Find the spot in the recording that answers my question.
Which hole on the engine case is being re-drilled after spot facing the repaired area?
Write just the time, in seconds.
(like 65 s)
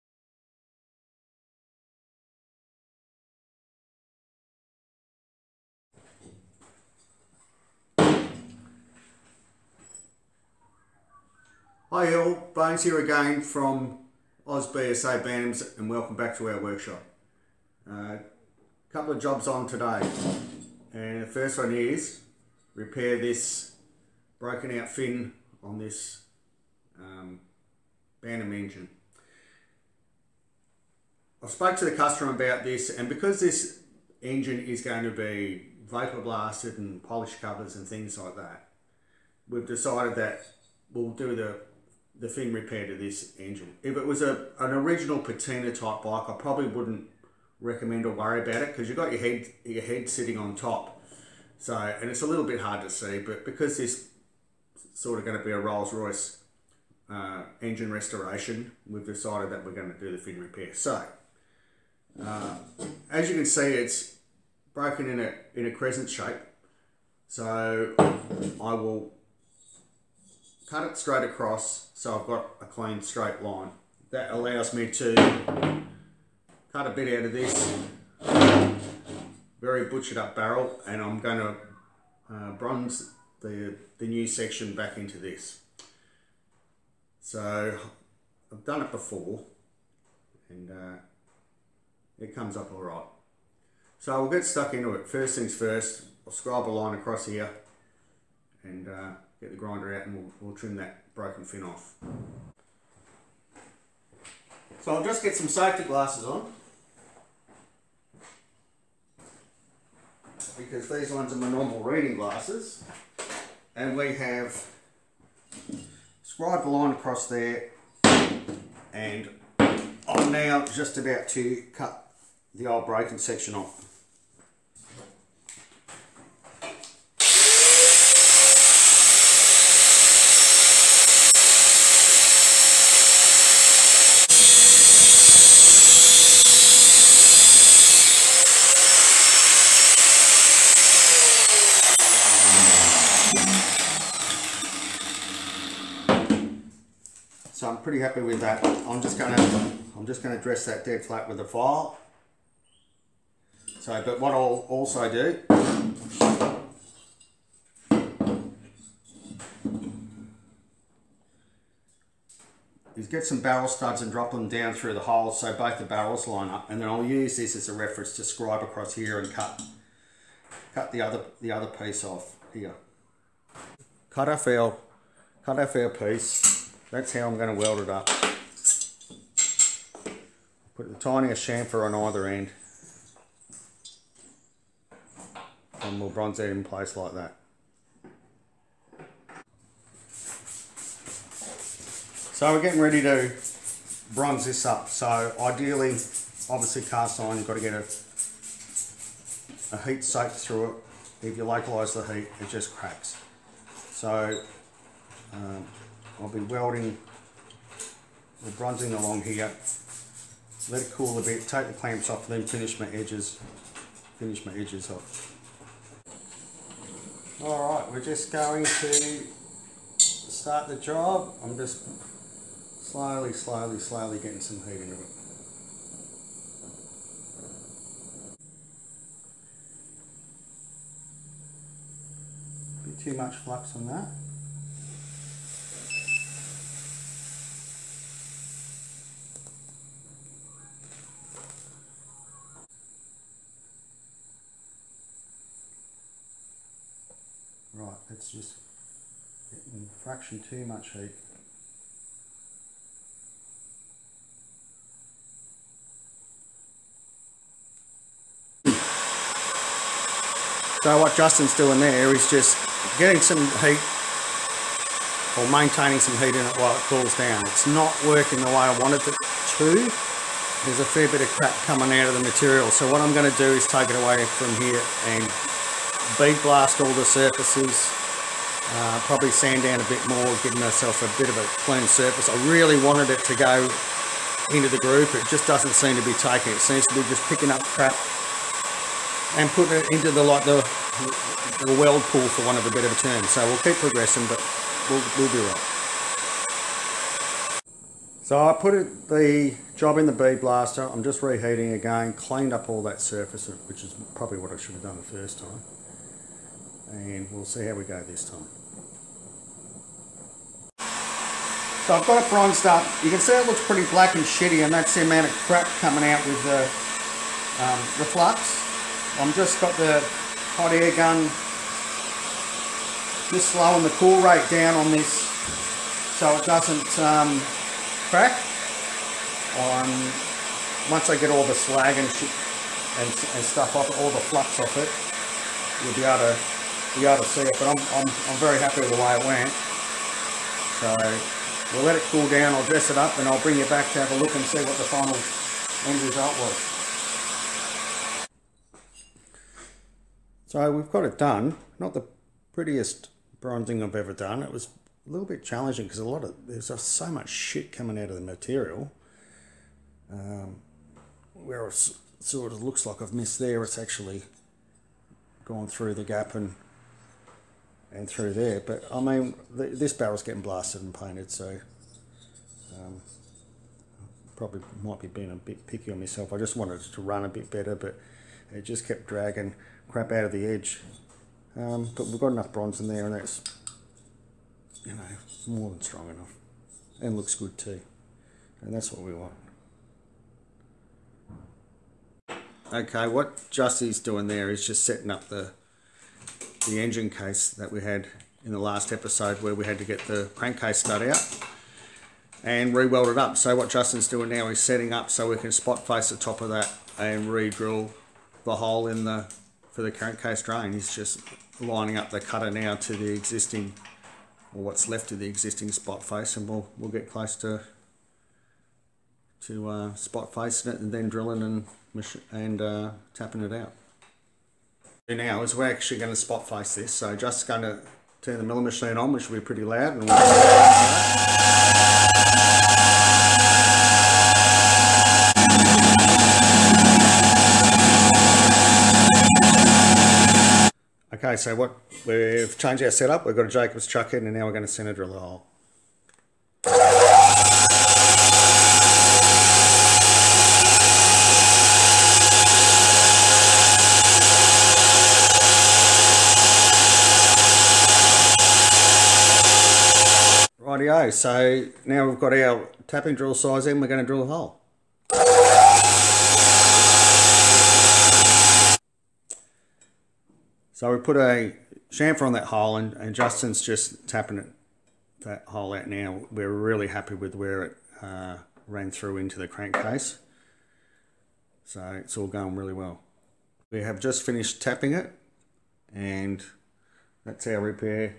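409 s.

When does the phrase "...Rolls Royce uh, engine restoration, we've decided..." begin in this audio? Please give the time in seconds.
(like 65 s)
55 s.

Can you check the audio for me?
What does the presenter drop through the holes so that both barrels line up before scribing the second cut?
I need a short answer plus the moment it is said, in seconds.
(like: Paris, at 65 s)
Barrel studs, at 163 s.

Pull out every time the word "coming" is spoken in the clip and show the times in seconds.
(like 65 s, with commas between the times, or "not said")
271 s, 315 s, 357 s.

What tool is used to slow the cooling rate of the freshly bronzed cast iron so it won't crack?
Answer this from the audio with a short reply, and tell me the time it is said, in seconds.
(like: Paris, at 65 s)
Hot air gun, at 320 s.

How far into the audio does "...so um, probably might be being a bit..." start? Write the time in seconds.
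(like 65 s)
371 s.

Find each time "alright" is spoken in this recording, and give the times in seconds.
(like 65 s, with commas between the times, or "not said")
92 s, 217 s.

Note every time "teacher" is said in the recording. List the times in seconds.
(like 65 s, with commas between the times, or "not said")
not said.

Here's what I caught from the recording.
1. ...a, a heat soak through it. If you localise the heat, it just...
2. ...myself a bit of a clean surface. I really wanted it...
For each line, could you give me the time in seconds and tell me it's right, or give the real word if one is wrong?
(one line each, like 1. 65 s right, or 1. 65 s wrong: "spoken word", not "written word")
1. 197 s right
2. 280 s right.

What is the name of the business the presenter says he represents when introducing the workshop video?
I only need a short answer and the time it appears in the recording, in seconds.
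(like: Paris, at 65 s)
OzBSA Bantams, at 14 s.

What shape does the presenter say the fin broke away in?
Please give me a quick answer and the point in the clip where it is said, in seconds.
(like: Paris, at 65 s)
Crescent, at 65 s.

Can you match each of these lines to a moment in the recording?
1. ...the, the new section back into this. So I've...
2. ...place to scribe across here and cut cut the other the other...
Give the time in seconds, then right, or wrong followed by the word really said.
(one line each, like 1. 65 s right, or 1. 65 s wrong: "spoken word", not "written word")
1. 83 s right
2. 167 s wrong: "reference", not "place".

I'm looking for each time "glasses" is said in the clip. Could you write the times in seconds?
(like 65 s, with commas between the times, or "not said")
105 s, 112 s.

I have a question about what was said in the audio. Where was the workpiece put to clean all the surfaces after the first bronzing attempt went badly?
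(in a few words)
Bead blaster.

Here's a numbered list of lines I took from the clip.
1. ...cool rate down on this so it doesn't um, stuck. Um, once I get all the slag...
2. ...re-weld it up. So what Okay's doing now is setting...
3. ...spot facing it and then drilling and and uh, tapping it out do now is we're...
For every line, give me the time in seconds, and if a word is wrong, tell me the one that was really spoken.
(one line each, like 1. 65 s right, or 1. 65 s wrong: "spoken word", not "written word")
1. 323 s wrong: "crack", not "stuck"
2. 402 s wrong: "Justin", not "Okay"
3. 419 s right.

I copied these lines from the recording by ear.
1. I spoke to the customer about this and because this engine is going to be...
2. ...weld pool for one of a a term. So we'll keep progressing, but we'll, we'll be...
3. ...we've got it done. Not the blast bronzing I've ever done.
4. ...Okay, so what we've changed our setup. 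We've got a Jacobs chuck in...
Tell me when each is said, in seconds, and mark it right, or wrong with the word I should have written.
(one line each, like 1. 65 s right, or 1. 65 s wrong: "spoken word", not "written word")
1. 31 s right
2. 291 s right
3. 350 s wrong: "prettiest", not "blast"
4. 441 s right.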